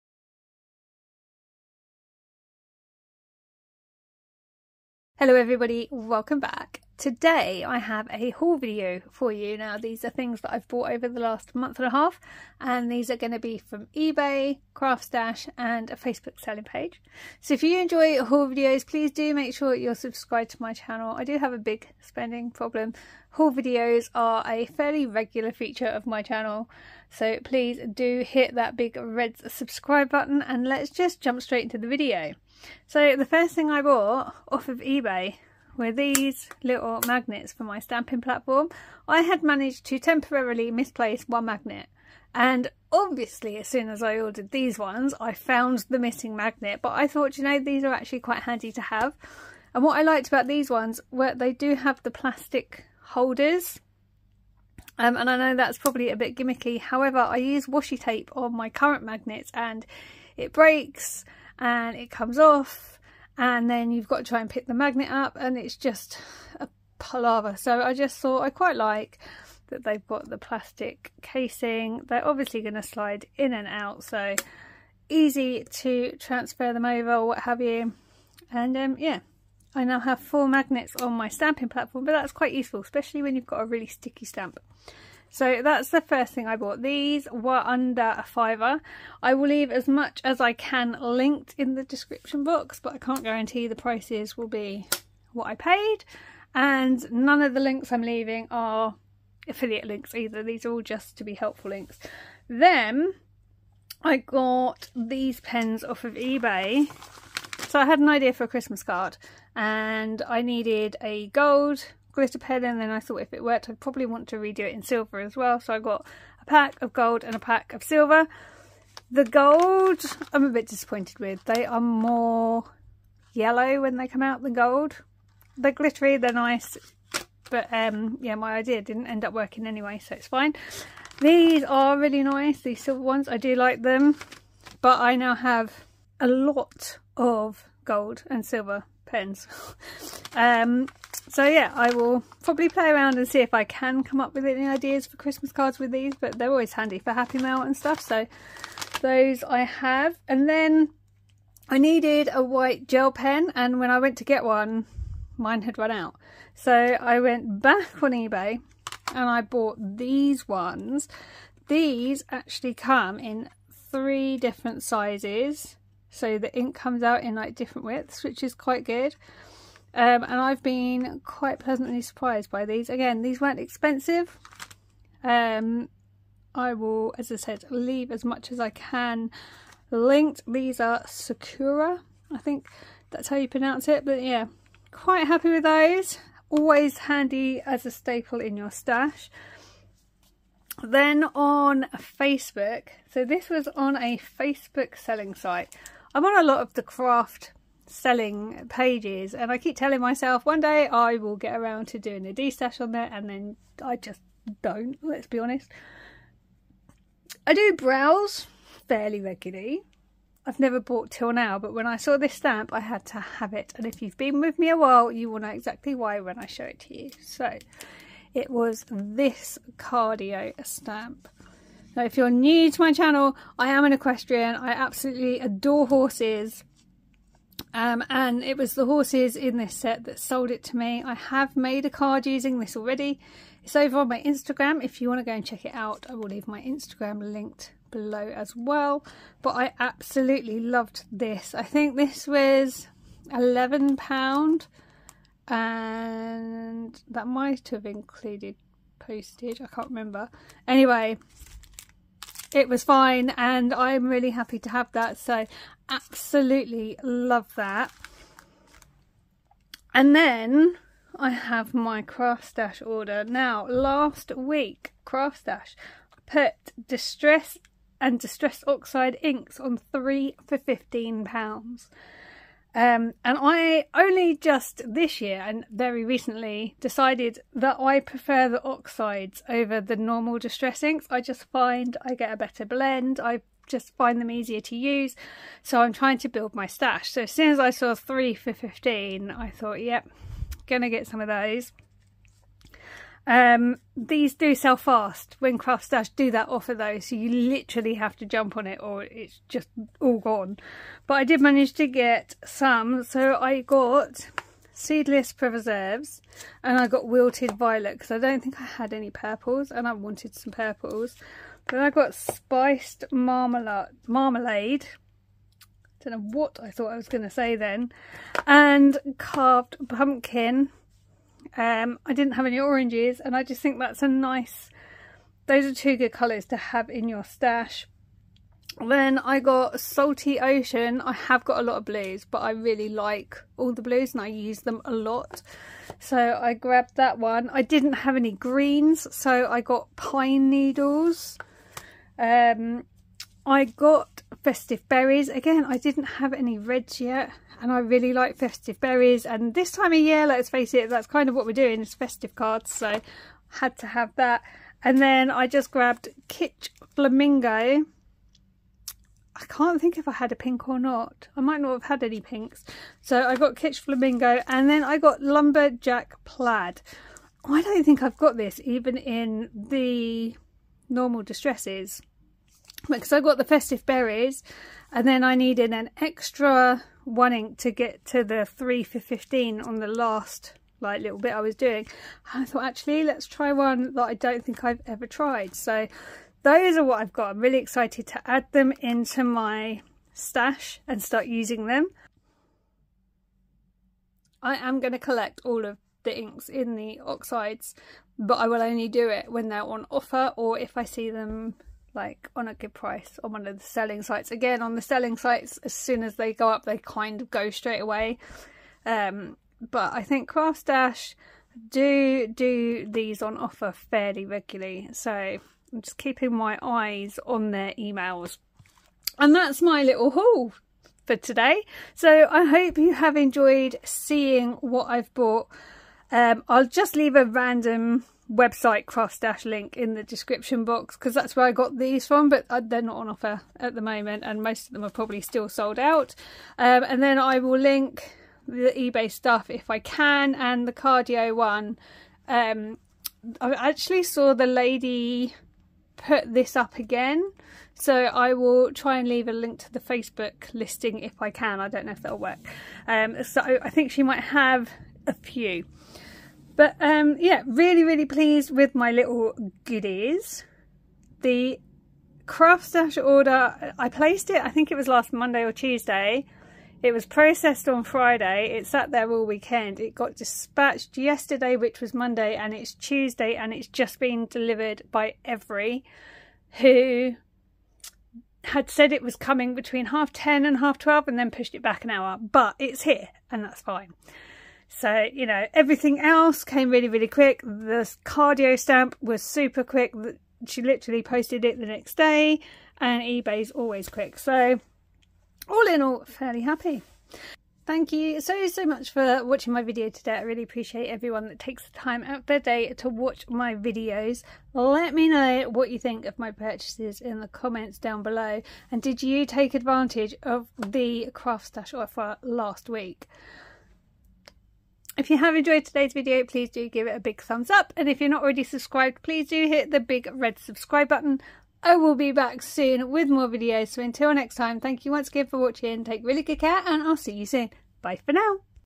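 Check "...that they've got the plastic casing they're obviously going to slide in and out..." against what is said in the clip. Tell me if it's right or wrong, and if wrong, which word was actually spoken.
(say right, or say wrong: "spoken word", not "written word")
right.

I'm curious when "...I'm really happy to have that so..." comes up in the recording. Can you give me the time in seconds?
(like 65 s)
253 s.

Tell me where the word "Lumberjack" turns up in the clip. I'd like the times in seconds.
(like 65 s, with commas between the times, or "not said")
365 s.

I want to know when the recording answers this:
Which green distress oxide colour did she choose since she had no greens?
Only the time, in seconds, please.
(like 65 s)
339 s.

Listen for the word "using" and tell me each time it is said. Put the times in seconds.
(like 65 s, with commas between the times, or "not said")
232 s, 391 s.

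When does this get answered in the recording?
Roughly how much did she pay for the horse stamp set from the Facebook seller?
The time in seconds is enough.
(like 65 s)
243 s.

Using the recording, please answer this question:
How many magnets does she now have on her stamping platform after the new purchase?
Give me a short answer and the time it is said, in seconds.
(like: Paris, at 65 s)
4, at 80 s.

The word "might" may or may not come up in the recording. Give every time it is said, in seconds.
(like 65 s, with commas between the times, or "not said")
247 s, 361 s, 454 s.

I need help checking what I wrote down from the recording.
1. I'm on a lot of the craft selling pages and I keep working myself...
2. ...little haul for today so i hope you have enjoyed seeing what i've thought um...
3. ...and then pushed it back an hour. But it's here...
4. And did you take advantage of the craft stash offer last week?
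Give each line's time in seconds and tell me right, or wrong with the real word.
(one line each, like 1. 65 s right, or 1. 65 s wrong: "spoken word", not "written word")
1. 196 s wrong: "telling", not "working"
2. 419 s wrong: "bought", not "thought"
3. 481 s right
4. 508 s right.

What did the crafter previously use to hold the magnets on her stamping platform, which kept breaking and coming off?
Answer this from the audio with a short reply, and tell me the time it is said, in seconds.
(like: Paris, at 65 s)
Washi tape, at 57 s.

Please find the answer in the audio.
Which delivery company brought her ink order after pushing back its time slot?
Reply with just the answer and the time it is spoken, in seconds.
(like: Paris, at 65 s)
Evri, at 475 s.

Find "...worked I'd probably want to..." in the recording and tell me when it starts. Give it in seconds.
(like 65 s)
113 s.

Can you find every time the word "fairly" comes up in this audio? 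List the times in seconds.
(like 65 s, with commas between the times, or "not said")
24 s, 208 s, 413 s, 496 s.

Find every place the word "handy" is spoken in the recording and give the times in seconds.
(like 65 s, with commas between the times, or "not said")
48 s, 146 s, 186 s.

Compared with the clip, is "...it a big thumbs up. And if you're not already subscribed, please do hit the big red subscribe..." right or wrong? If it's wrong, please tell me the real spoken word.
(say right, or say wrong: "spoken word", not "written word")
right.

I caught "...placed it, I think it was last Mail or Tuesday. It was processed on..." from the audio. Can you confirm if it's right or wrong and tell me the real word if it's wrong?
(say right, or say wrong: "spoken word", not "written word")
wrong: "Monday", not "Mail".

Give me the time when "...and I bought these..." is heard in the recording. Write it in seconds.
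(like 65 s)
159 s.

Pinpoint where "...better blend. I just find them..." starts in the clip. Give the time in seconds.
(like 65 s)
282 s.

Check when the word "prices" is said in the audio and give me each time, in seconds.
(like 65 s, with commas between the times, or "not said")
93 s, 402 s.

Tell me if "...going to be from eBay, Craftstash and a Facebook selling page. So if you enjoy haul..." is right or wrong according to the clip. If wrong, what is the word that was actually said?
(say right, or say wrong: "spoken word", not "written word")
right.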